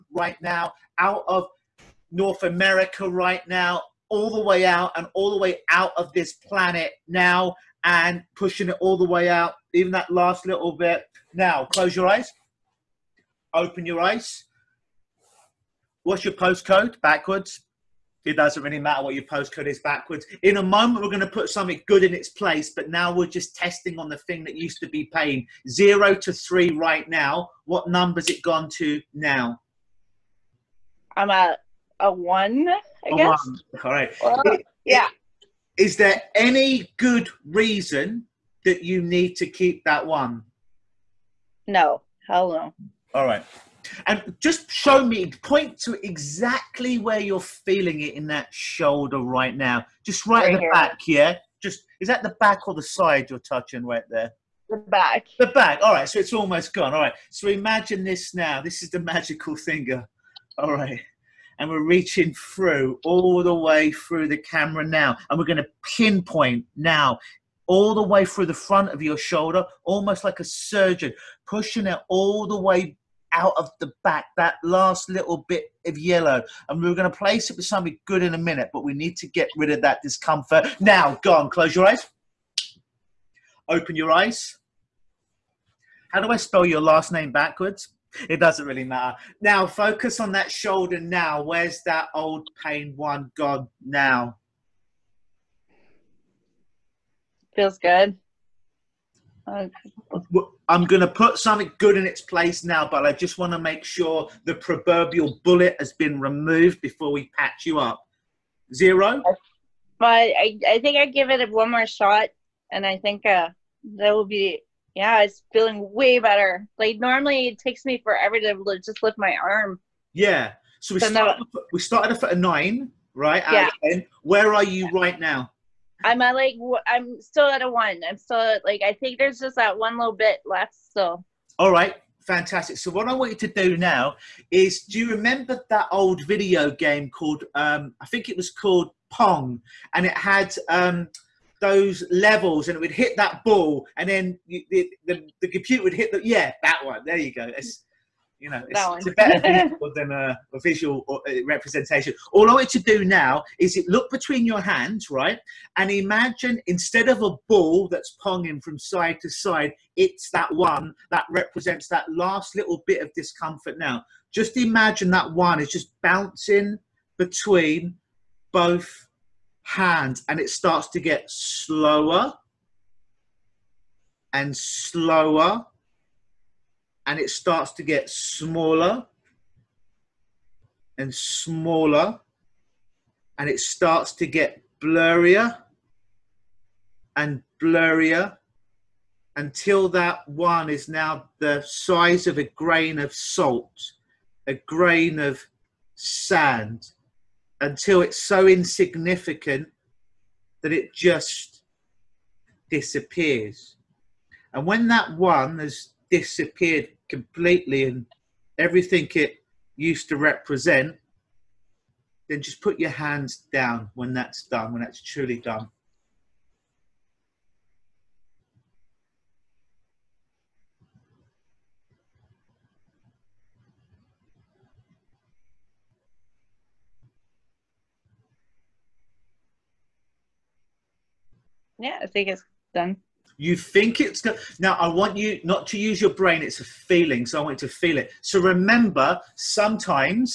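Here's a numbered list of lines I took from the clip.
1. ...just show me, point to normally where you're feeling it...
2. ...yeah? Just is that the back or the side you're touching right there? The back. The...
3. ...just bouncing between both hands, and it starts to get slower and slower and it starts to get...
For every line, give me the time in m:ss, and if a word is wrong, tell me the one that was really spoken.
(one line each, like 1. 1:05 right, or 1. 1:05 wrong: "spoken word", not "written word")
1. 0:44 wrong: "exactly", not "normally"
2. 0:51 right
3. 2:45 right.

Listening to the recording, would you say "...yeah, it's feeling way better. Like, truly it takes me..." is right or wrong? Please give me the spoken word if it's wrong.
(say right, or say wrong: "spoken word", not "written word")
wrong: "normally", not "truly".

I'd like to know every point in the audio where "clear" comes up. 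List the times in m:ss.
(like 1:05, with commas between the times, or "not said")
not said.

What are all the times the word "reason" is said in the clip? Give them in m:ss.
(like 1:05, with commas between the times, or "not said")
0:37.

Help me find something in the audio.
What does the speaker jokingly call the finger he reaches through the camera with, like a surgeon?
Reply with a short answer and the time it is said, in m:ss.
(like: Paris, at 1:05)
Magical finger, at 0:58.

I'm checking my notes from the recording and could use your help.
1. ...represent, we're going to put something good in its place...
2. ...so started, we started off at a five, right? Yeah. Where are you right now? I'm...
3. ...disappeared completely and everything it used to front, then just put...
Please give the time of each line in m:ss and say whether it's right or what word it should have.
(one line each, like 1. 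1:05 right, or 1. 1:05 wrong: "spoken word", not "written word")
1. 0:20 wrong: "moment", not "represent"
2. 2:01 wrong: "nine", not "five"
3. 3:26 wrong: "represent", not "front".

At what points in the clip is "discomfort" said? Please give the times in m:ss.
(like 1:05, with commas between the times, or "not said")
1:20, 2:43.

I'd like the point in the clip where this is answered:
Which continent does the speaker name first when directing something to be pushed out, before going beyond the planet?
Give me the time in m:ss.
0:02.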